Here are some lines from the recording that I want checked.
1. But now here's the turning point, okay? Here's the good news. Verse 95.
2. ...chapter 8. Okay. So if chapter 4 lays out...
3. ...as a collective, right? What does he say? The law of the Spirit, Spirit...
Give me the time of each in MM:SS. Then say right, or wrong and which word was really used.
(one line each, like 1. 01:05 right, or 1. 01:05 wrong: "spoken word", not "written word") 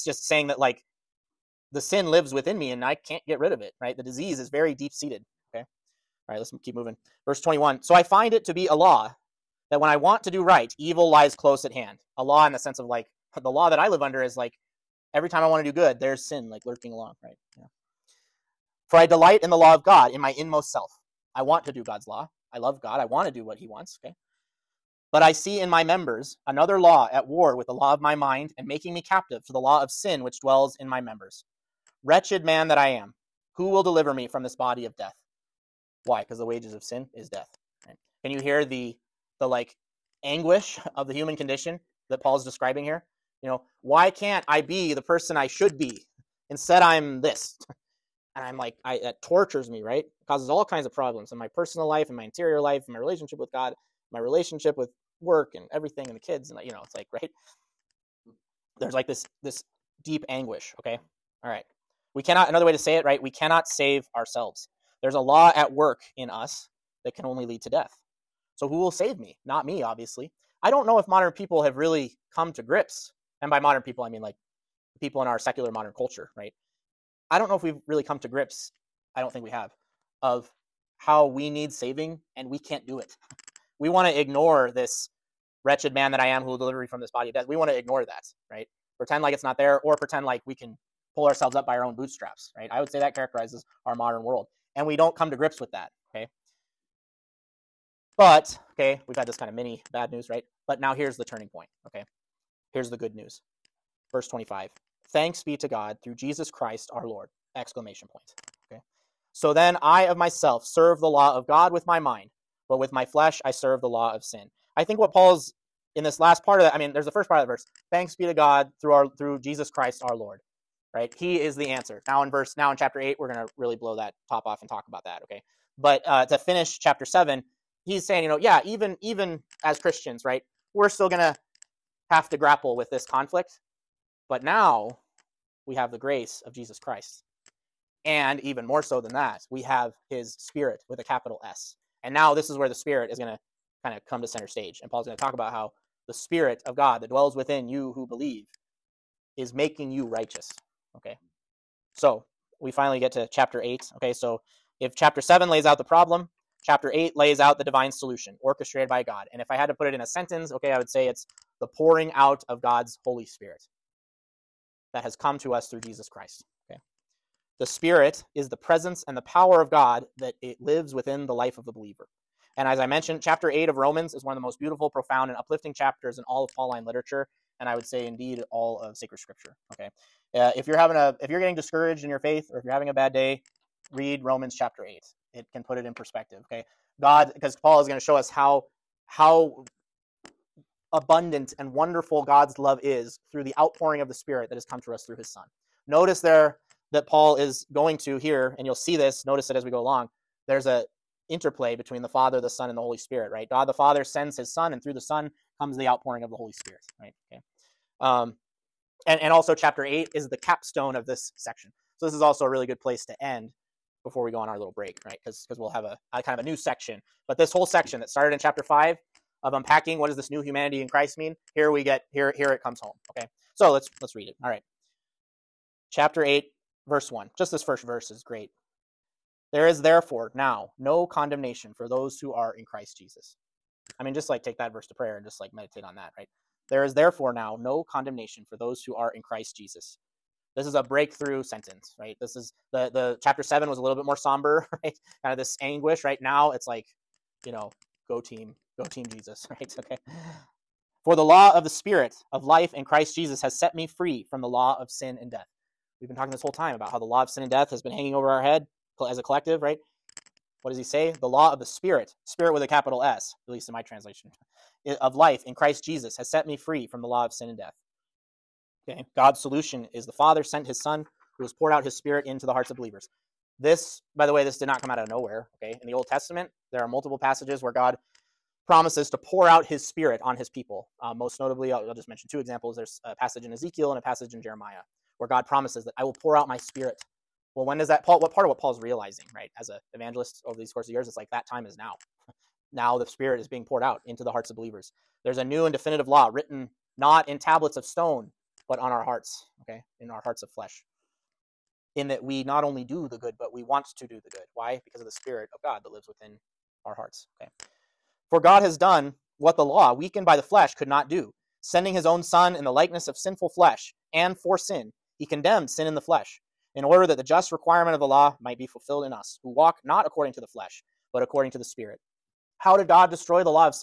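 1. 01:40 wrong: "25", not "95"
2. 02:33 wrong: "7", not "4"
3. 04:19 right.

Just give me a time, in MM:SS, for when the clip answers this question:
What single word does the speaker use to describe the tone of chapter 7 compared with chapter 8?
04:04.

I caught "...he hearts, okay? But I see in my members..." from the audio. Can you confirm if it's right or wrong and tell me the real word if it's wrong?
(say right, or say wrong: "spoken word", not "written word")
wrong: "wants", not "hearts".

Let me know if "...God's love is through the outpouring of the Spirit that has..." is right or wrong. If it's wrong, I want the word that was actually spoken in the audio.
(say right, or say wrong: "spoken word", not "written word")
right.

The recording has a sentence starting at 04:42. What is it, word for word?
There's a passage in Ezekiel and a passage in Jeremiah where God promises that I will pour out my spirit.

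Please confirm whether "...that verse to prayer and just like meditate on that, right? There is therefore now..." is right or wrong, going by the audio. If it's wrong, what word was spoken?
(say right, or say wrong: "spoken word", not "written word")
right.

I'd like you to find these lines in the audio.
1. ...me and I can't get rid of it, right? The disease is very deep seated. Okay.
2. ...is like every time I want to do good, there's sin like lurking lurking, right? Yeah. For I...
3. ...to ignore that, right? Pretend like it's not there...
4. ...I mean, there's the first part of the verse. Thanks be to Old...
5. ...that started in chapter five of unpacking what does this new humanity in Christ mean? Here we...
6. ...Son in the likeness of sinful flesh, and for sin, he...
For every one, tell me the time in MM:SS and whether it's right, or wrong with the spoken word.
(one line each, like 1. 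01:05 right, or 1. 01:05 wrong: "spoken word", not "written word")
1. 00:02 right
2. 00:14 wrong: "along", not "lurking"
3. 01:27 right
4. 01:56 wrong: "God", not "Old"
5. 03:38 right
6. 05:12 right.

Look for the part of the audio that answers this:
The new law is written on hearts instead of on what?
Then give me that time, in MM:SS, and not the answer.
04:57.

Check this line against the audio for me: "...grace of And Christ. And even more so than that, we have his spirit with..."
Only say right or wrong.
wrong.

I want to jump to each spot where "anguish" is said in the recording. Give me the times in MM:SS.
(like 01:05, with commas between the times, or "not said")
00:40, 01:00, 04:05.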